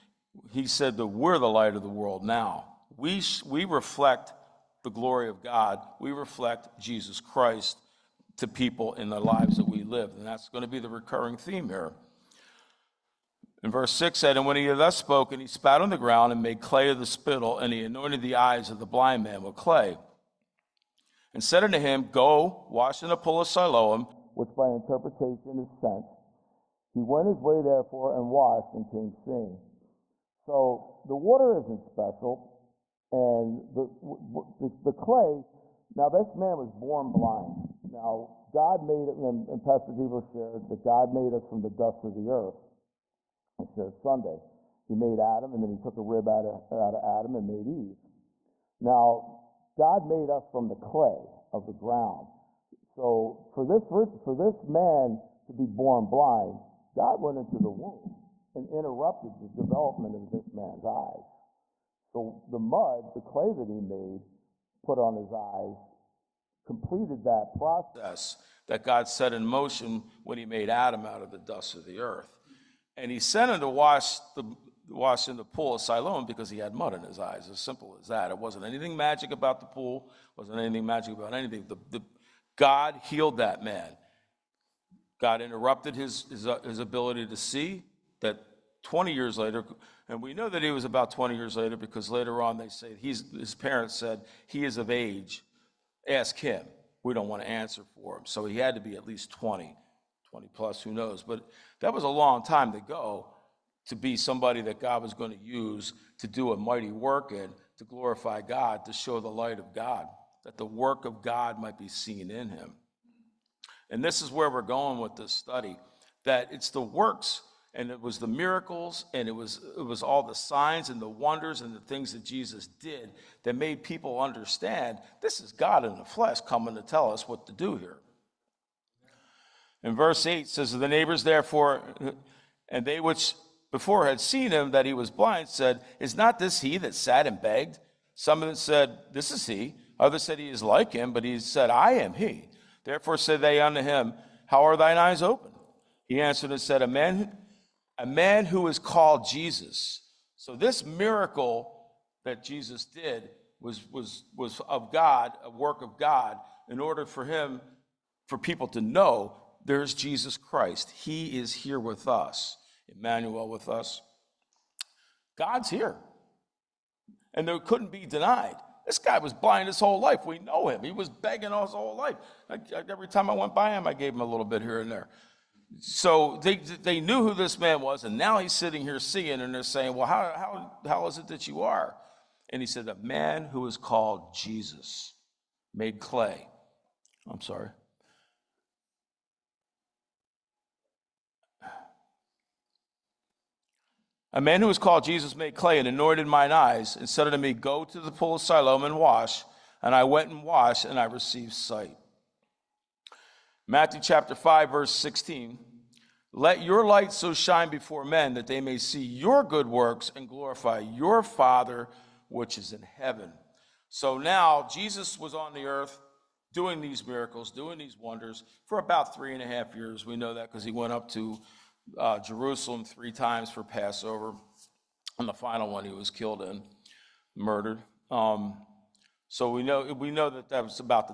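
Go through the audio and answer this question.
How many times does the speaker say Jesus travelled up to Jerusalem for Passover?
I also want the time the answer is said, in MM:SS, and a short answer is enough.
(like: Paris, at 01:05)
3 times, at 03:42.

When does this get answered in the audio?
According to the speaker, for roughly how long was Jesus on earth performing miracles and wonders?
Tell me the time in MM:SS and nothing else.
03:39.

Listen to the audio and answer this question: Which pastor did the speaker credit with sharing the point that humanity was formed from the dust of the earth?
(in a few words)
Pastor Giebel.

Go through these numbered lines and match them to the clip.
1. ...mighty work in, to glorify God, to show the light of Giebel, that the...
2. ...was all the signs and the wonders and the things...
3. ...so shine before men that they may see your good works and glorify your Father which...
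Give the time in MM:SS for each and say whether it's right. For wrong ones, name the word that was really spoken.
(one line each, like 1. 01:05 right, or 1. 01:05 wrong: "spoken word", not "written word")
1. 01:46 wrong: "God", not "Giebel"
2. 01:59 right
3. 03:27 right.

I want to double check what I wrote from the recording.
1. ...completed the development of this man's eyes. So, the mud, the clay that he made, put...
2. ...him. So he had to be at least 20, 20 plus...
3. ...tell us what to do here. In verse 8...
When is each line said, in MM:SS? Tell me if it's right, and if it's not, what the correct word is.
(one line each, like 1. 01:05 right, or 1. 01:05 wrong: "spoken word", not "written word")
1. 00:58 wrong: "interrupted", not "completed"
2. 01:38 right
3. 02:06 right.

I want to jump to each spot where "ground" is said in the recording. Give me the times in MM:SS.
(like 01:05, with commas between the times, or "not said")
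00:15, 00:51.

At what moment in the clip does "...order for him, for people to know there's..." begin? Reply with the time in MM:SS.
02:36.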